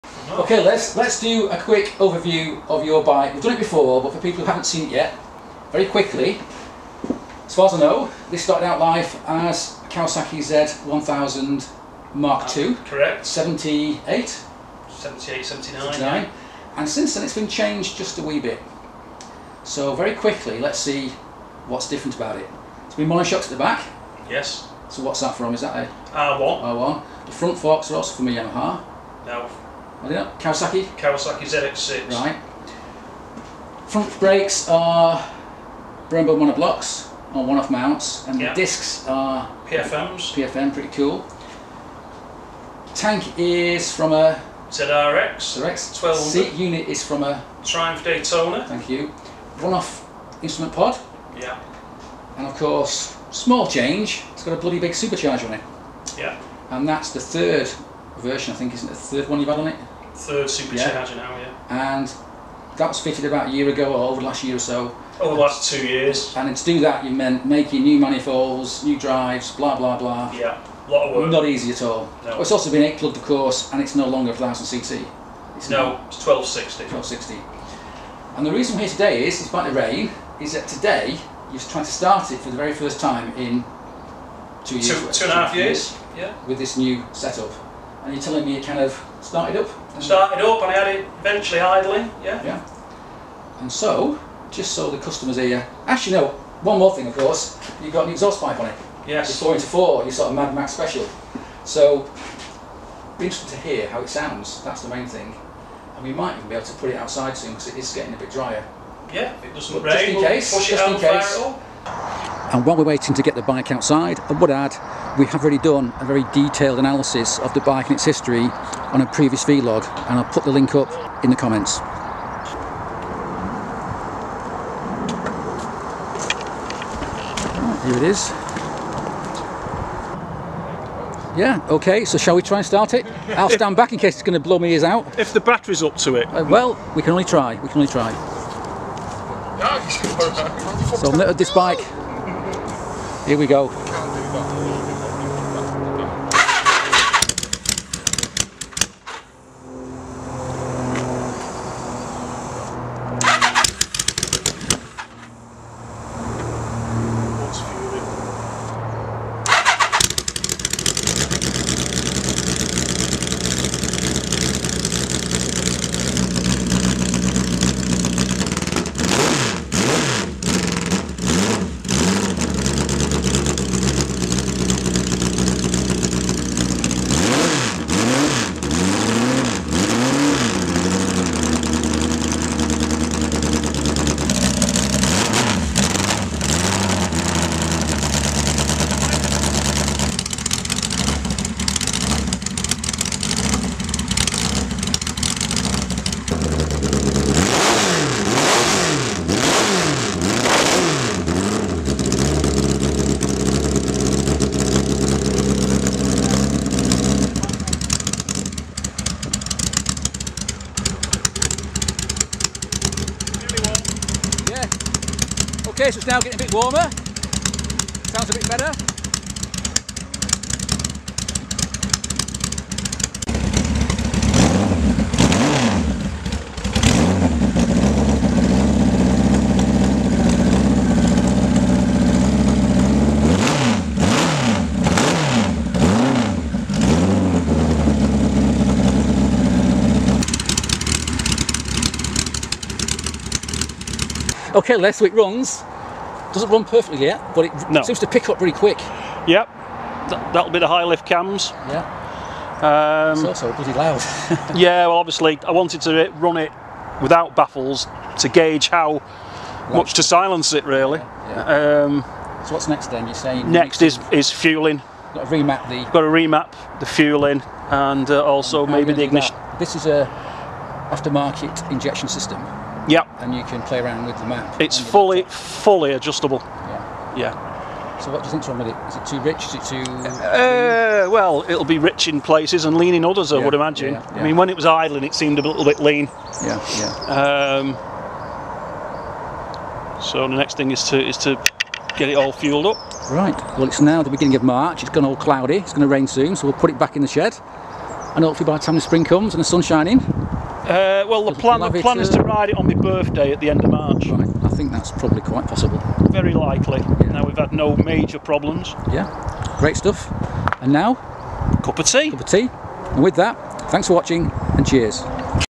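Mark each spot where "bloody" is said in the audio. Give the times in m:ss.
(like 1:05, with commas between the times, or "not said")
0:54, 4:13.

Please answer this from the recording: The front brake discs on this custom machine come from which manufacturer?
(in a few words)
PFM.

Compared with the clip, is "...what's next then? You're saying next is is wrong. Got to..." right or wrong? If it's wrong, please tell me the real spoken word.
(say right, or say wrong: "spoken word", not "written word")
wrong: "fueling", not "wrong".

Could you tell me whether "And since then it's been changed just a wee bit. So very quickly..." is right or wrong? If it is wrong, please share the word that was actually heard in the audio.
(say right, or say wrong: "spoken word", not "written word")
right.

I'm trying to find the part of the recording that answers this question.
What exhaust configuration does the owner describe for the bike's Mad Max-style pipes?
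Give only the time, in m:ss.
1:39.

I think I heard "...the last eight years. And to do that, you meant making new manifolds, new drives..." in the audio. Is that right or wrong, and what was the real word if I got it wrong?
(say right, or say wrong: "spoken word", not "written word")
wrong: "two", not "eight".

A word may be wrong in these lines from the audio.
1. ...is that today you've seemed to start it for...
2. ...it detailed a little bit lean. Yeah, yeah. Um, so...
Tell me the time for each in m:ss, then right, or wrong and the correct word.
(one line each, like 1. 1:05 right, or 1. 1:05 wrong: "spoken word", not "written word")
1. 1:20 wrong: "tried", not "seemed"
2. 4:45 wrong: "seemed", not "detailed".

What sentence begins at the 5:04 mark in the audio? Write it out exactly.
Right, I think that's probably quite possible.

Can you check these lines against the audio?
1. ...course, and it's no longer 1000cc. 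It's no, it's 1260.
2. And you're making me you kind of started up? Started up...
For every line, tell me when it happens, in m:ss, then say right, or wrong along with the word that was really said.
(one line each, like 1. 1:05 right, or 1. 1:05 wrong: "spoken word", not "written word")
1. 1:13 right
2. 1:28 wrong: "telling", not "making".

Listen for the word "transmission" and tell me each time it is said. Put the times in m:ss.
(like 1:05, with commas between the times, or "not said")
not said.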